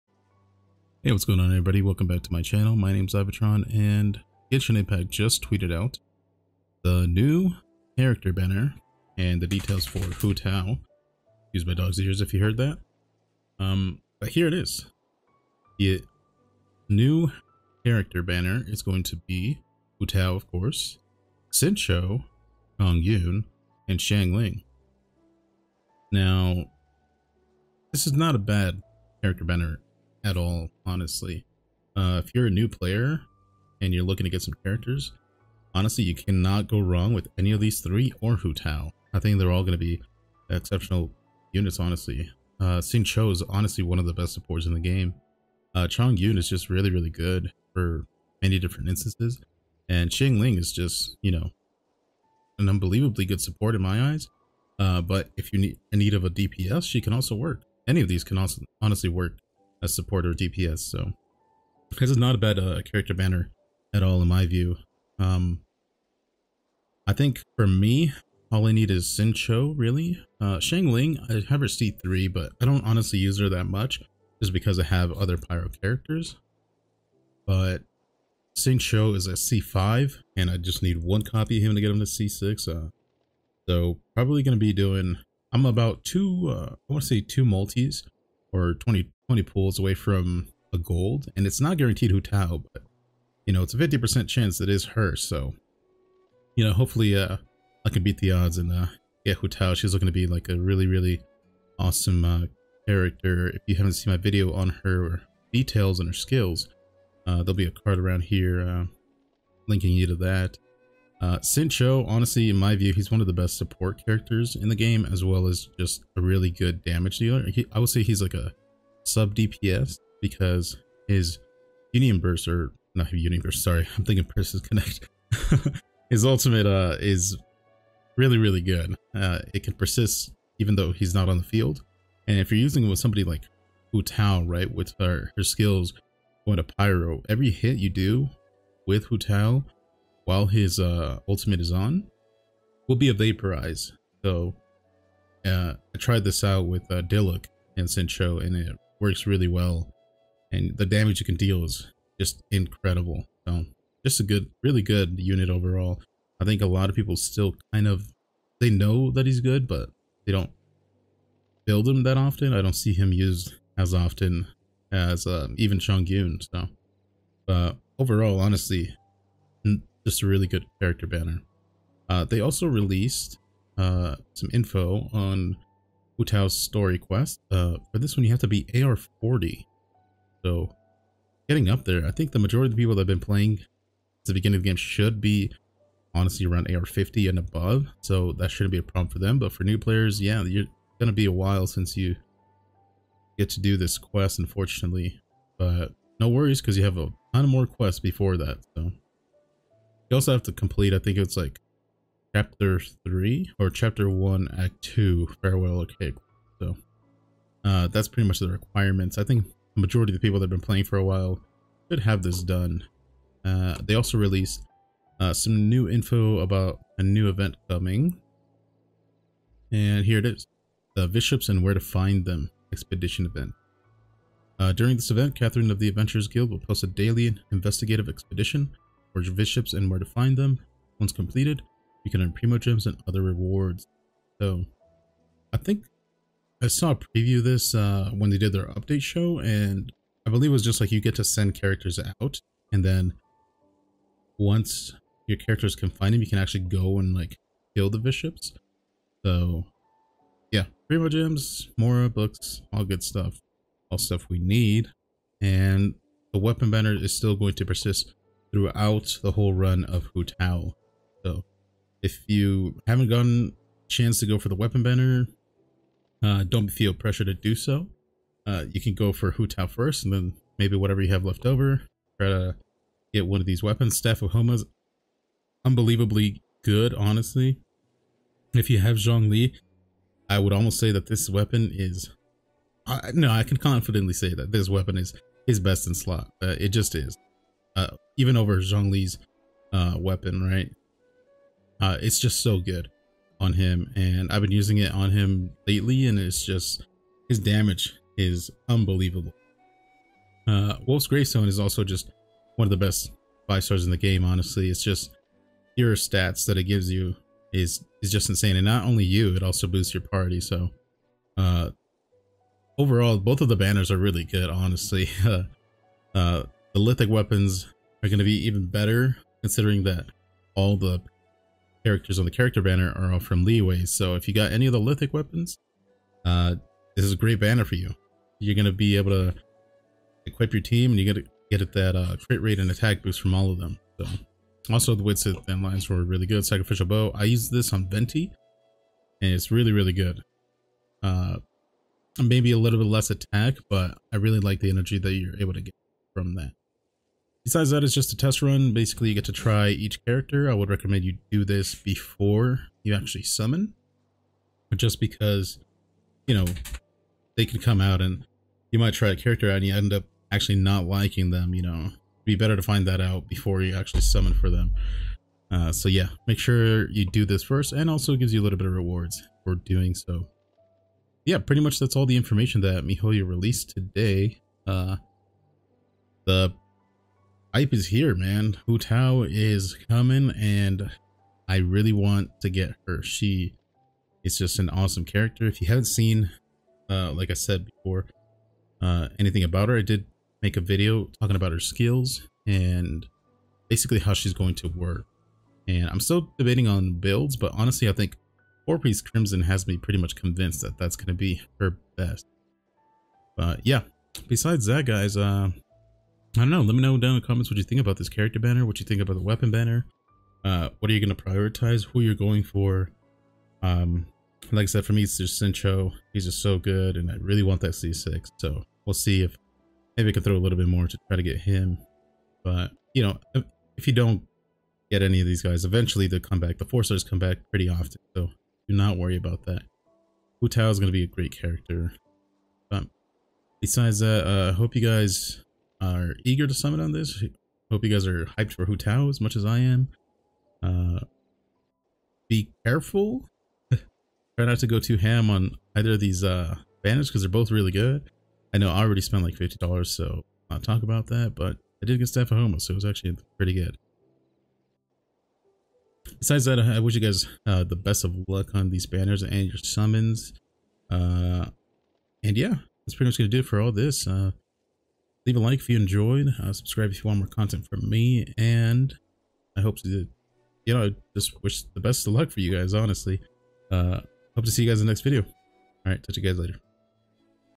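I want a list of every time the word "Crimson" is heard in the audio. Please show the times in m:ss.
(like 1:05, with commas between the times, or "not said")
6:39.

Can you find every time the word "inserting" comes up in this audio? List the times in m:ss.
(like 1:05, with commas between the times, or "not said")
not said.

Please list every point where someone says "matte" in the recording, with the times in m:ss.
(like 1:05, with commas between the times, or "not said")
not said.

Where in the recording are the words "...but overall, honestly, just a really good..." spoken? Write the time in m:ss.
2:47.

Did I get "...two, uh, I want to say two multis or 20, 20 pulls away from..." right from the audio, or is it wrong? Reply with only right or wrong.
right.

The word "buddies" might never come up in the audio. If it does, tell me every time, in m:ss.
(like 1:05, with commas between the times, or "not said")
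not said.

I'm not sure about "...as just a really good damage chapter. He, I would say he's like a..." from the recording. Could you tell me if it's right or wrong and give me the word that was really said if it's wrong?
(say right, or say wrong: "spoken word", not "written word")
wrong: "dealer", not "chapter".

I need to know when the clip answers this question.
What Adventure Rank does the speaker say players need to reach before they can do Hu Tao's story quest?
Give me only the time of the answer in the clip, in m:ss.
2:58.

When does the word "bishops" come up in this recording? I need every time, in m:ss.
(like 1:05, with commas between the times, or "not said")
3:41, 3:49, 4:07.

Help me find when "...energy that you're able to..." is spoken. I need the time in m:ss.
5:44.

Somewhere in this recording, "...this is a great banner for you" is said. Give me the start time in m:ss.
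5:26.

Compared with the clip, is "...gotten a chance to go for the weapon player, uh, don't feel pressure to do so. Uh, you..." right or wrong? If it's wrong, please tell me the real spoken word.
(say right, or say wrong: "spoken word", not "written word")
wrong: "banner", not "player".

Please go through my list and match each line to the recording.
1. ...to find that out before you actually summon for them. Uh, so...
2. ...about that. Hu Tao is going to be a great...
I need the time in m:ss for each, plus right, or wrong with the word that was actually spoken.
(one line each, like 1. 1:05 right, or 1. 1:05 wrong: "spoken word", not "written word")
1. 6:02 right
2. 7:09 right.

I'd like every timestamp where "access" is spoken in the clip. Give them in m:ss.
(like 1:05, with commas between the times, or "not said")
not said.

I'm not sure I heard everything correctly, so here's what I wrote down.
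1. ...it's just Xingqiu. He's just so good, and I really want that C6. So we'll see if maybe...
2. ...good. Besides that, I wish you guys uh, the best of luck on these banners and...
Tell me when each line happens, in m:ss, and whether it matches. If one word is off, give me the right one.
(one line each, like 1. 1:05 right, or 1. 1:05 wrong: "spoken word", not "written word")
1. 6:55 right
2. 7:33 right.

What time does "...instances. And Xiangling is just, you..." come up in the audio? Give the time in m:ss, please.
0:48.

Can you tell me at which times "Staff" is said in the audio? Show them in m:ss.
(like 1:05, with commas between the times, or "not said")
4:33, 7:32.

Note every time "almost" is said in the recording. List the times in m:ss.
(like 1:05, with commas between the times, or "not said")
4:40.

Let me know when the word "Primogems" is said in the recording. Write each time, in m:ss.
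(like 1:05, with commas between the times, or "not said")
3:52, 4:10.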